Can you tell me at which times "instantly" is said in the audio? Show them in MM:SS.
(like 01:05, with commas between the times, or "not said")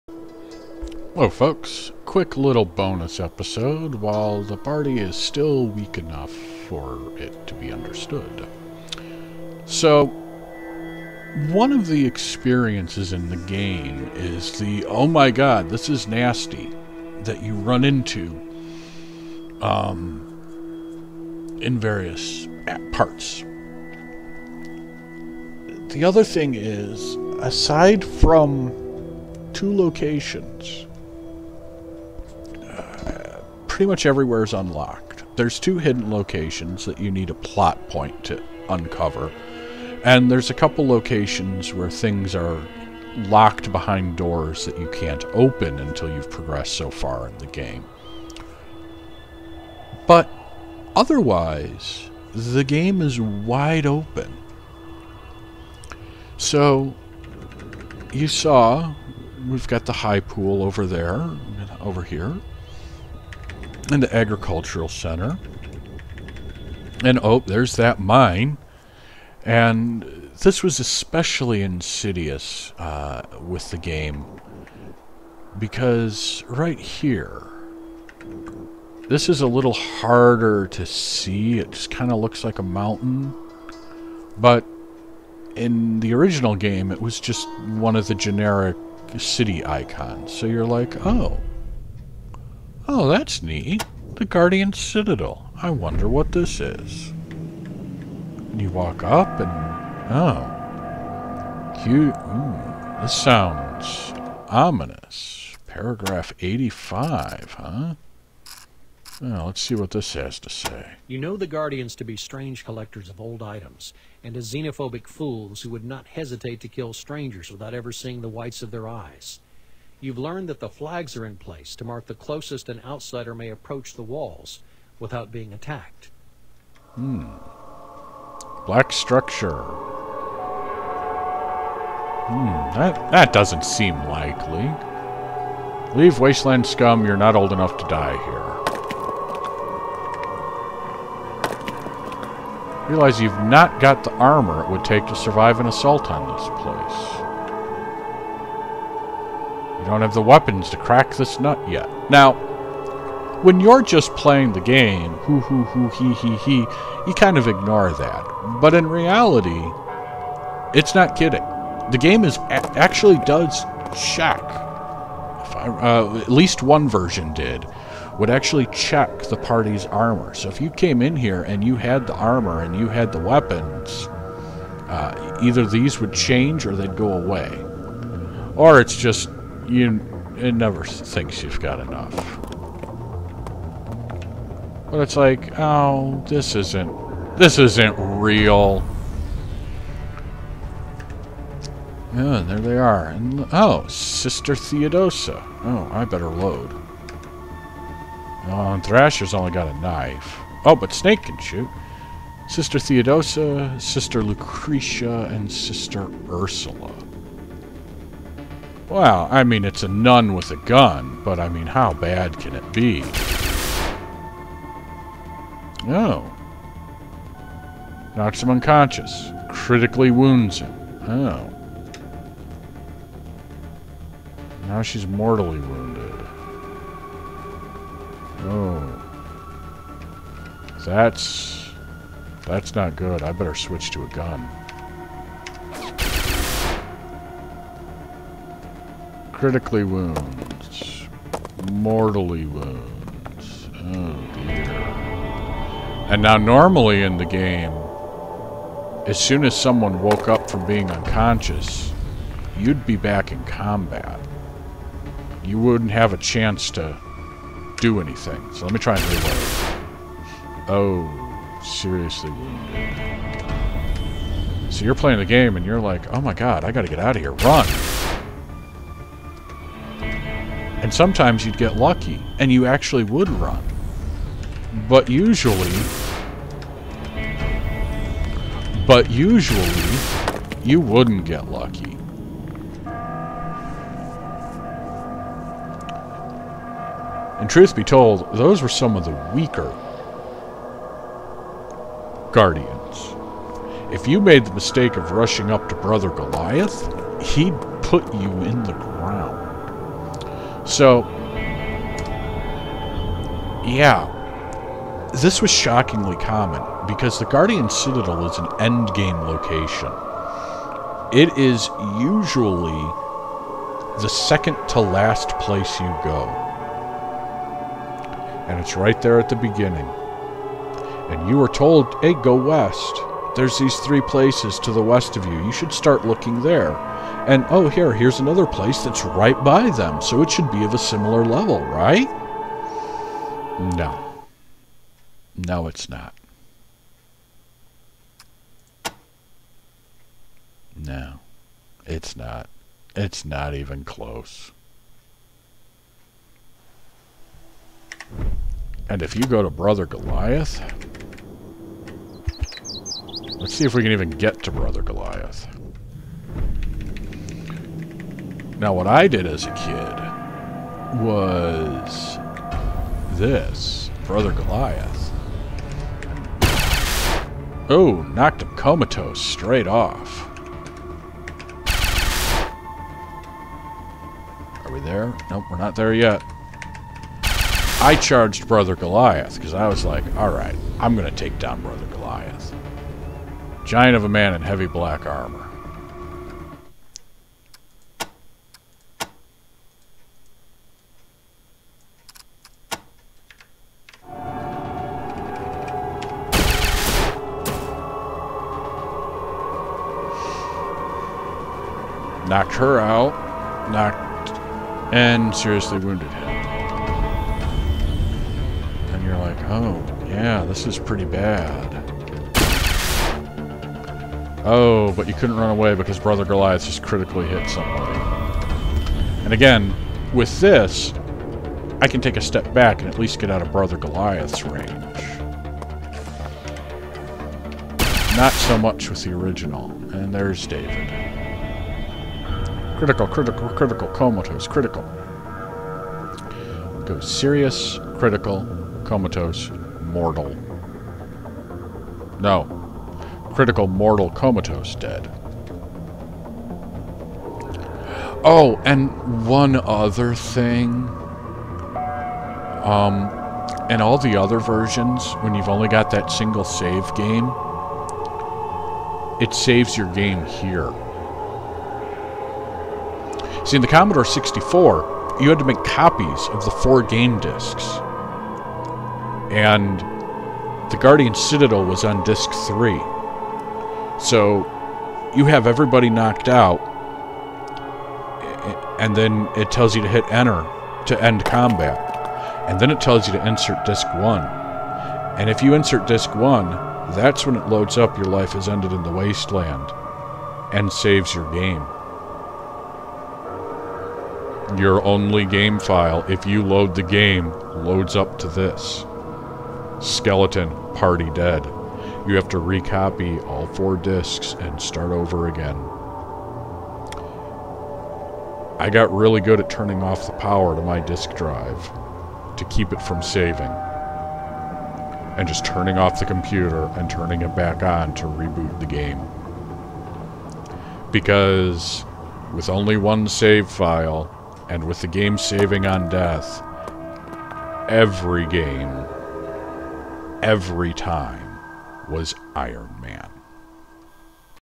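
not said.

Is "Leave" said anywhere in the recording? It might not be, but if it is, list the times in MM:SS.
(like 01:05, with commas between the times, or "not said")
02:15.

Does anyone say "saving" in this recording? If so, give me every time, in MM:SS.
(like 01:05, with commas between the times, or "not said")
08:33, 08:45.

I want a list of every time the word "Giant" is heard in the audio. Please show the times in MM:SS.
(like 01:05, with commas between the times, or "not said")
06:23.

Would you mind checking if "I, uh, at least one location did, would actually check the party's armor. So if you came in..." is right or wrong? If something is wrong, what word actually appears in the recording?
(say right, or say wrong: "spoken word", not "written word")
wrong: "version", not "location".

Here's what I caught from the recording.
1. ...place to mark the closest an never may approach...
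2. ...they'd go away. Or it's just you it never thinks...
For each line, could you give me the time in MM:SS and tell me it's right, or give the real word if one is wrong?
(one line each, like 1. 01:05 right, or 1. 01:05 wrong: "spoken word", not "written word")
1. 02:01 wrong: "outsider", not "never"
2. 02:56 right.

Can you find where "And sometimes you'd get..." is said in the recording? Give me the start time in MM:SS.
04:30.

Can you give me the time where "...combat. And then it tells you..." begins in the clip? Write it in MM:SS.
08:01.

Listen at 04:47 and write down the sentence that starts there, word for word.
And truth be told, those were some of the weaker Guardians.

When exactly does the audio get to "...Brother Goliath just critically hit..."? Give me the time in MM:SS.
06:55.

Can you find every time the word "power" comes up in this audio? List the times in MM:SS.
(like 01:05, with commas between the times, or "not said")
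08:30.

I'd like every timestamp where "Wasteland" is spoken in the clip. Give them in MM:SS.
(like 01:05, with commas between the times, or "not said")
02:16, 08:08.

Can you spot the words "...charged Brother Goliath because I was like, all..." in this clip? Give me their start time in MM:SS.
06:17.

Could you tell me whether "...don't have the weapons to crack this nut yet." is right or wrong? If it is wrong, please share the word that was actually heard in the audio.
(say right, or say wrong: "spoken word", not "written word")
right.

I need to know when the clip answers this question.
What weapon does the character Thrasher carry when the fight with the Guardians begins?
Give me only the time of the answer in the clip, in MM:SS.
03:19.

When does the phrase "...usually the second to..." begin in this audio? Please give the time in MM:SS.
05:11.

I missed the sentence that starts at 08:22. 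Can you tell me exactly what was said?
You have to recopy all four discs and start over again.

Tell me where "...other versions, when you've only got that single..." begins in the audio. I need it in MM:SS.
07:34.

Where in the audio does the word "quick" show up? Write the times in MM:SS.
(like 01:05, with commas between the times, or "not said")
00:02.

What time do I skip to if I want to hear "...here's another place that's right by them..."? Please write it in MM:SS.
05:27.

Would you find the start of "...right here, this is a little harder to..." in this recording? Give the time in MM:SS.
01:16.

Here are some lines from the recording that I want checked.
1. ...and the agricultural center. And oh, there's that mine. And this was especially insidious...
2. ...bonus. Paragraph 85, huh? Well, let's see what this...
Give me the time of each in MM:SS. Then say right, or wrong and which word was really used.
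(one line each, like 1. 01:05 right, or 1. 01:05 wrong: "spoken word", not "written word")
1. 01:03 right
2. 01:44 wrong: "ominous", not "bonus".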